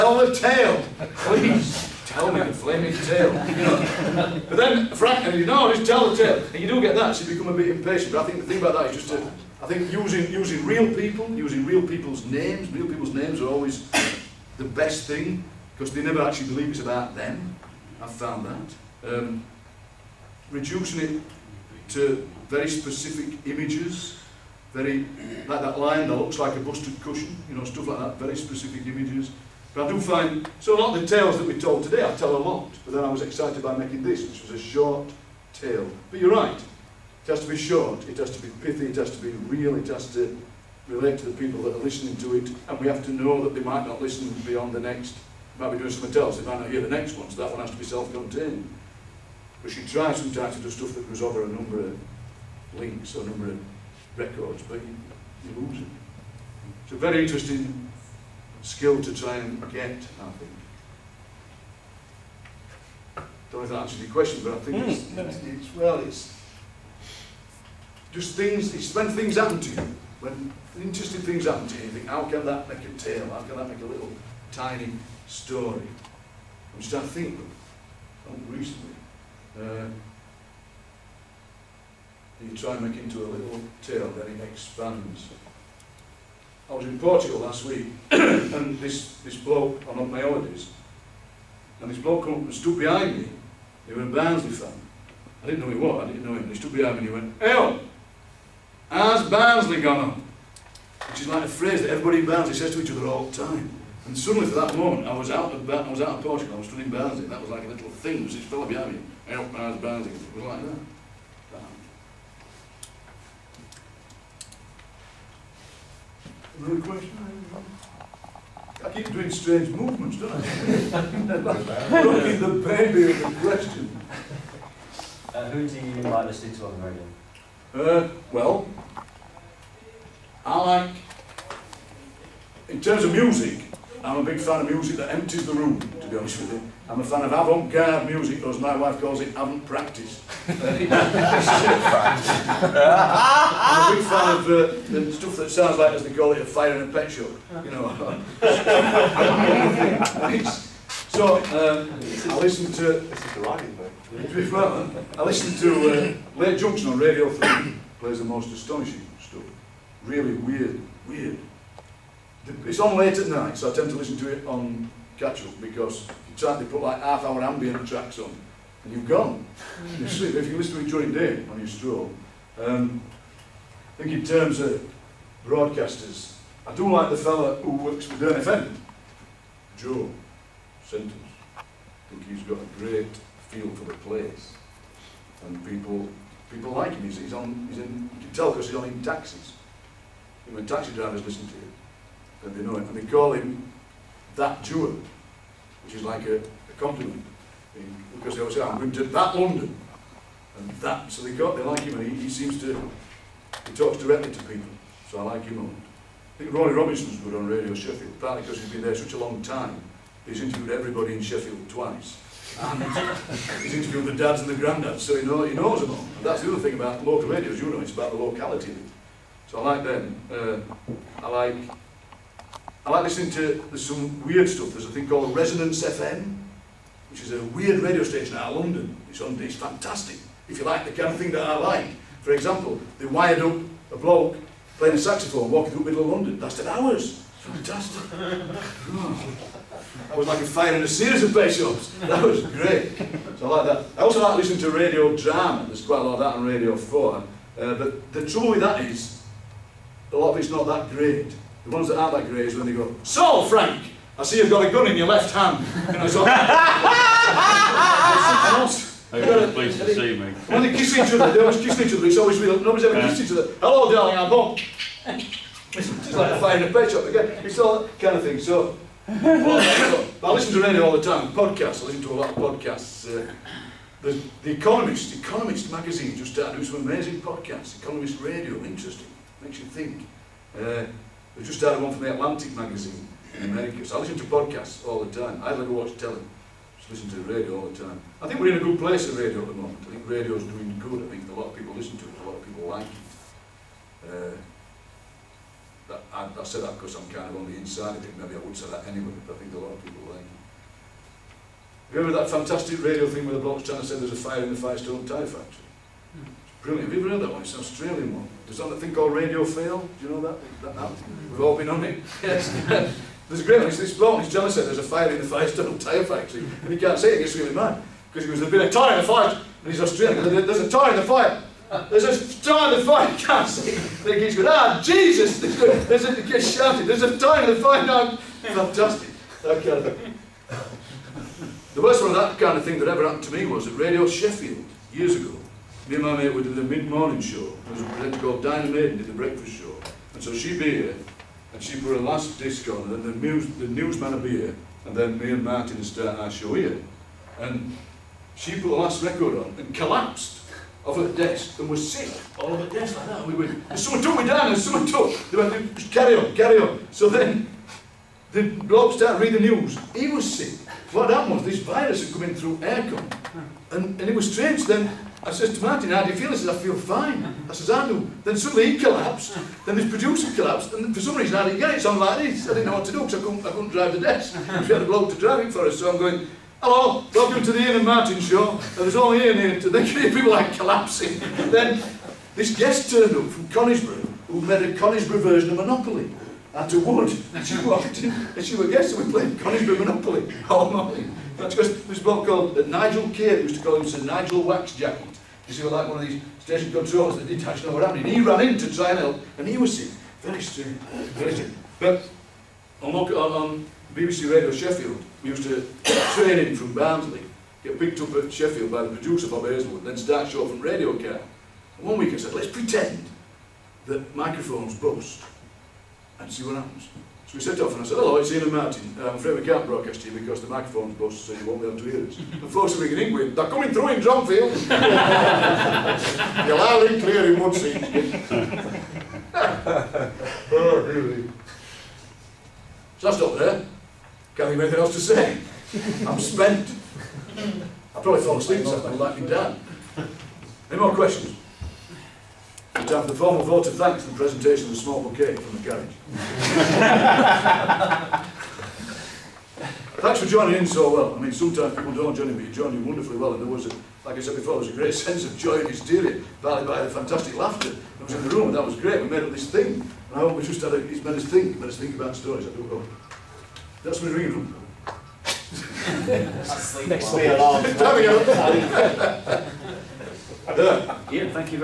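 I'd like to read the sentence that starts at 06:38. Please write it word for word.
And he ran in to try and help, and he was sick.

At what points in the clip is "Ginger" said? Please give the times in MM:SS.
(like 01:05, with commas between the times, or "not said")
not said.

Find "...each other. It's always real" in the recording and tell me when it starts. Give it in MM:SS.
04:21.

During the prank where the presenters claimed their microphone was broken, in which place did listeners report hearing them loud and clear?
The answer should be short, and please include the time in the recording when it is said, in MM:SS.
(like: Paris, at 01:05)
Dronfield, at 07:04.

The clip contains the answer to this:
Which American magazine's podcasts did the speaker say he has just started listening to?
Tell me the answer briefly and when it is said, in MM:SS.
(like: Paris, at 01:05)
The Atlantic, at 04:42.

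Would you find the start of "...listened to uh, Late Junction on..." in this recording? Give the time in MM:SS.
02:35.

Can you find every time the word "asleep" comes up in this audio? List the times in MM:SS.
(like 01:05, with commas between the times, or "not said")
07:18.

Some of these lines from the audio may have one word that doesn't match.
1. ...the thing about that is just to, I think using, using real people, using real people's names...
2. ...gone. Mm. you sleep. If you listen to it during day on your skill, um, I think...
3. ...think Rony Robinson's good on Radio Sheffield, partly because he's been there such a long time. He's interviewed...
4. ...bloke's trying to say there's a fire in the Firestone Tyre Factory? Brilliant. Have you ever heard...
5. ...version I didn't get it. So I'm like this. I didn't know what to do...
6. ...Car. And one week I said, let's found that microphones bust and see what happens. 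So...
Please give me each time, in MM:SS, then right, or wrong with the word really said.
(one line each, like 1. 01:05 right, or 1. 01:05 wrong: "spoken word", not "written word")
1. 00:08 right
2. 02:49 wrong: "stroll", not "skill"
3. 03:26 right
4. 05:03 right
5. 06:11 wrong: "reason", not "version"
6. 06:50 wrong: "pretend", not "found".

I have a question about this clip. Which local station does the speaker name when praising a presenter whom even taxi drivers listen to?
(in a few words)
Dearne FM.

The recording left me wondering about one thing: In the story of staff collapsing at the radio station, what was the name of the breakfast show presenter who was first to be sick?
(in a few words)
Dinah Maiden.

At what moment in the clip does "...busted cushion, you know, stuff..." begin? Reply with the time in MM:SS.
00:26.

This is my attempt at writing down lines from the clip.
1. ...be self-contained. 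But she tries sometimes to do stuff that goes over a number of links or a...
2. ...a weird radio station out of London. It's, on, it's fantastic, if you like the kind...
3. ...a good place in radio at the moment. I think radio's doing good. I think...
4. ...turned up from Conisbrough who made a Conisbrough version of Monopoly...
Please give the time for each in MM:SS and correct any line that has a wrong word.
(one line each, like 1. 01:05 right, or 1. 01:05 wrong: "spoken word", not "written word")
1. 00:47 right
2. 03:47 right
3. 04:48 right
4. 06:22 right.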